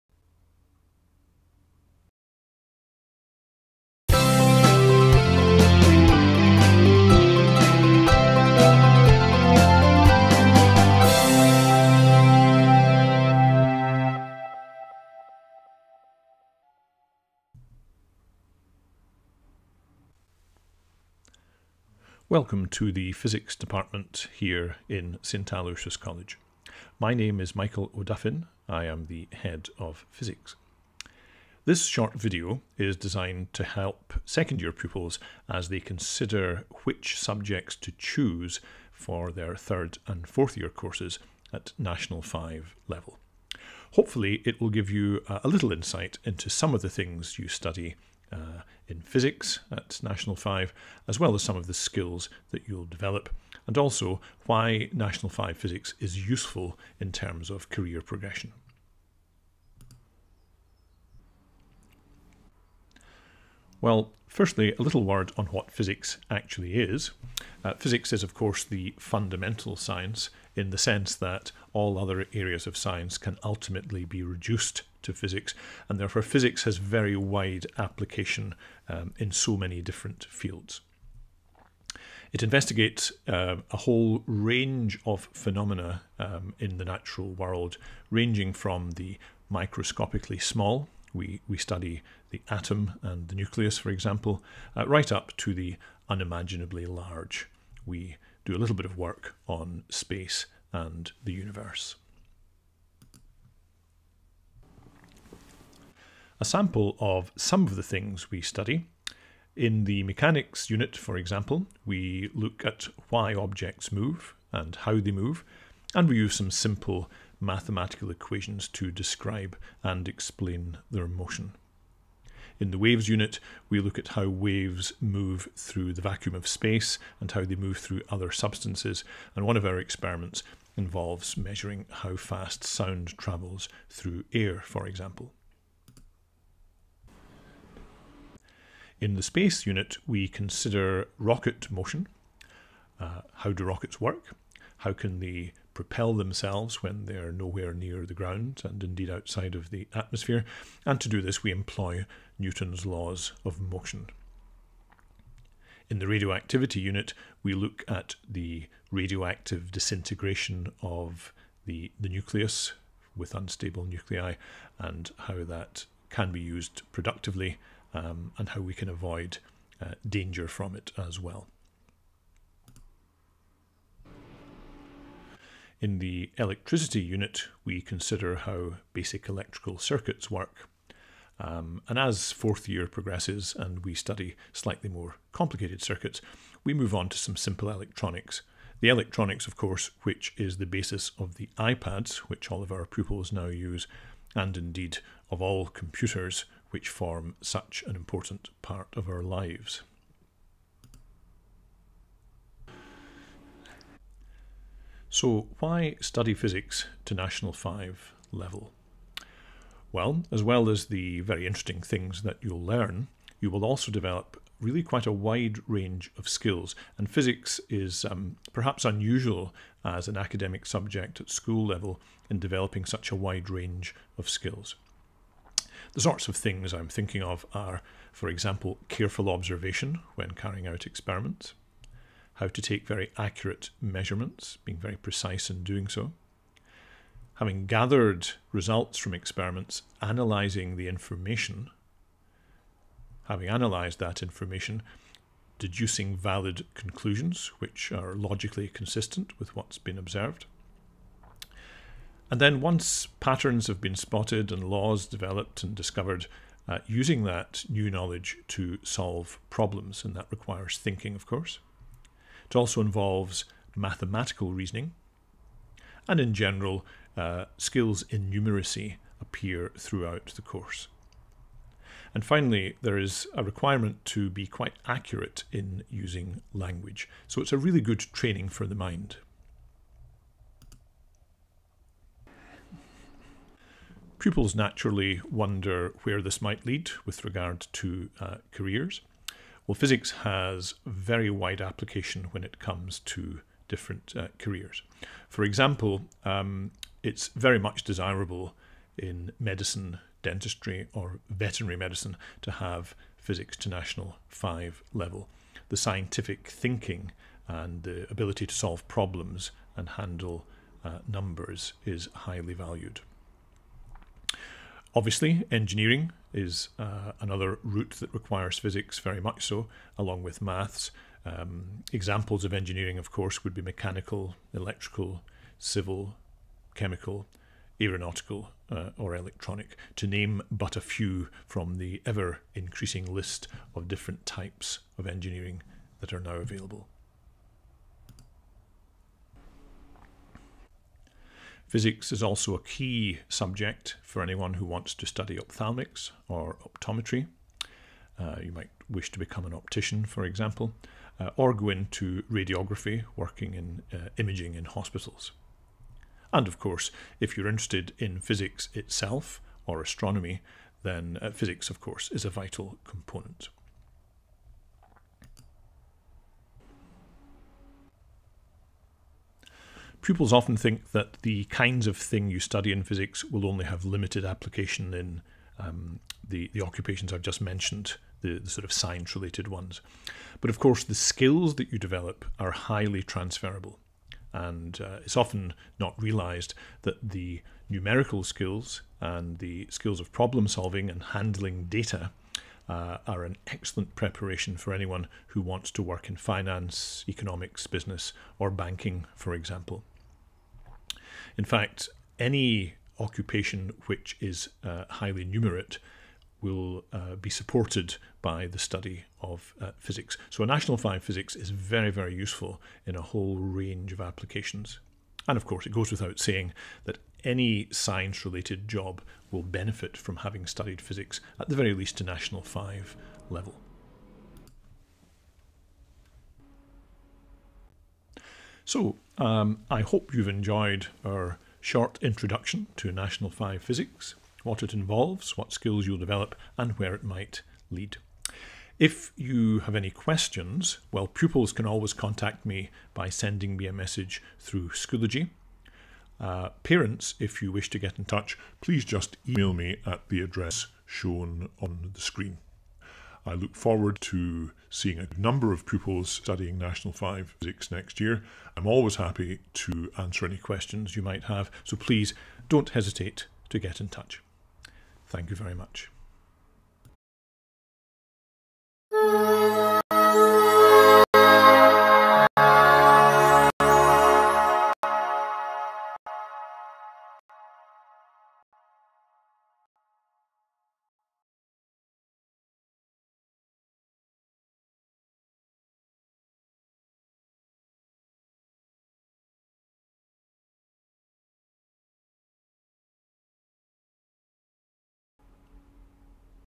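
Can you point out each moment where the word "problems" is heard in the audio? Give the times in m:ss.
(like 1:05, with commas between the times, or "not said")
4:19, 5:08, 6:30.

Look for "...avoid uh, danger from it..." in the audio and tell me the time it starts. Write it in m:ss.
2:48.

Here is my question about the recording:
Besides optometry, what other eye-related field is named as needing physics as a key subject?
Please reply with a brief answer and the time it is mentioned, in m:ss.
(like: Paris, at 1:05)
Ophthalmics, at 5:45.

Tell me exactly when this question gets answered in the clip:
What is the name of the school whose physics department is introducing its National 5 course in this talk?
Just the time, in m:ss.
0:25.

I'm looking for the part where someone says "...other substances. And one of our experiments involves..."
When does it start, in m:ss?
2:08.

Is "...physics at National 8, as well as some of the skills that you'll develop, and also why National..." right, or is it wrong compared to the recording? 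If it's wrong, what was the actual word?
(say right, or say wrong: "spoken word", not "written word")
wrong: "5", not "8".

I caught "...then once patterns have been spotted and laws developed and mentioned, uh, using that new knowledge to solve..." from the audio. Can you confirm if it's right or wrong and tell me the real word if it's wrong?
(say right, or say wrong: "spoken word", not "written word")
wrong: "discovered", not "mentioned".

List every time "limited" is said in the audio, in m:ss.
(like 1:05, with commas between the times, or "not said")
6:13.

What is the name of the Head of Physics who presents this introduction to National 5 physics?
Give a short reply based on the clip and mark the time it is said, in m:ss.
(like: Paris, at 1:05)
Michael O'Duffin, at 0:27.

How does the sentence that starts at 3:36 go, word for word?
And physics is um, perhaps unusual as an academic subject at school level in developing such a wide range of skills.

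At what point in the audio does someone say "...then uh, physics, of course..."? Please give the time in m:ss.
6:00.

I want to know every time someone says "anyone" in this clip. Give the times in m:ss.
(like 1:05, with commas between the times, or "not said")
5:44, 6:34.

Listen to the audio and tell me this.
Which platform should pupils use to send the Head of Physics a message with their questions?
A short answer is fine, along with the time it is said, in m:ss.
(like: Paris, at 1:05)
Schoology, at 7:24.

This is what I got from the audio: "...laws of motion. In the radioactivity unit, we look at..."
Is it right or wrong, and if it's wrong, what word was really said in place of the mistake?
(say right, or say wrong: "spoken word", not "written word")
right.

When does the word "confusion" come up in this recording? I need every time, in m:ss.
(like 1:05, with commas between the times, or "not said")
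not said.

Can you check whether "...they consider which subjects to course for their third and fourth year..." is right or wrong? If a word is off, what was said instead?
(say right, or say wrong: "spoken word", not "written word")
wrong: "choose", not "course".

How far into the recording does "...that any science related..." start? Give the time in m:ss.
6:56.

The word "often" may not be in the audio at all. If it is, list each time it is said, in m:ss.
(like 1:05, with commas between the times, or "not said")
6:10, 6:25.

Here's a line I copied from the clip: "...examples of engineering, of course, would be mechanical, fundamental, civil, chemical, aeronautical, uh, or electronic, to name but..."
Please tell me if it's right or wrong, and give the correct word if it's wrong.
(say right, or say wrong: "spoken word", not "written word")
wrong: "electrical", not "fundamental".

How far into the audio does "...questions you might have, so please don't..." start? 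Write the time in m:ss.
7:40.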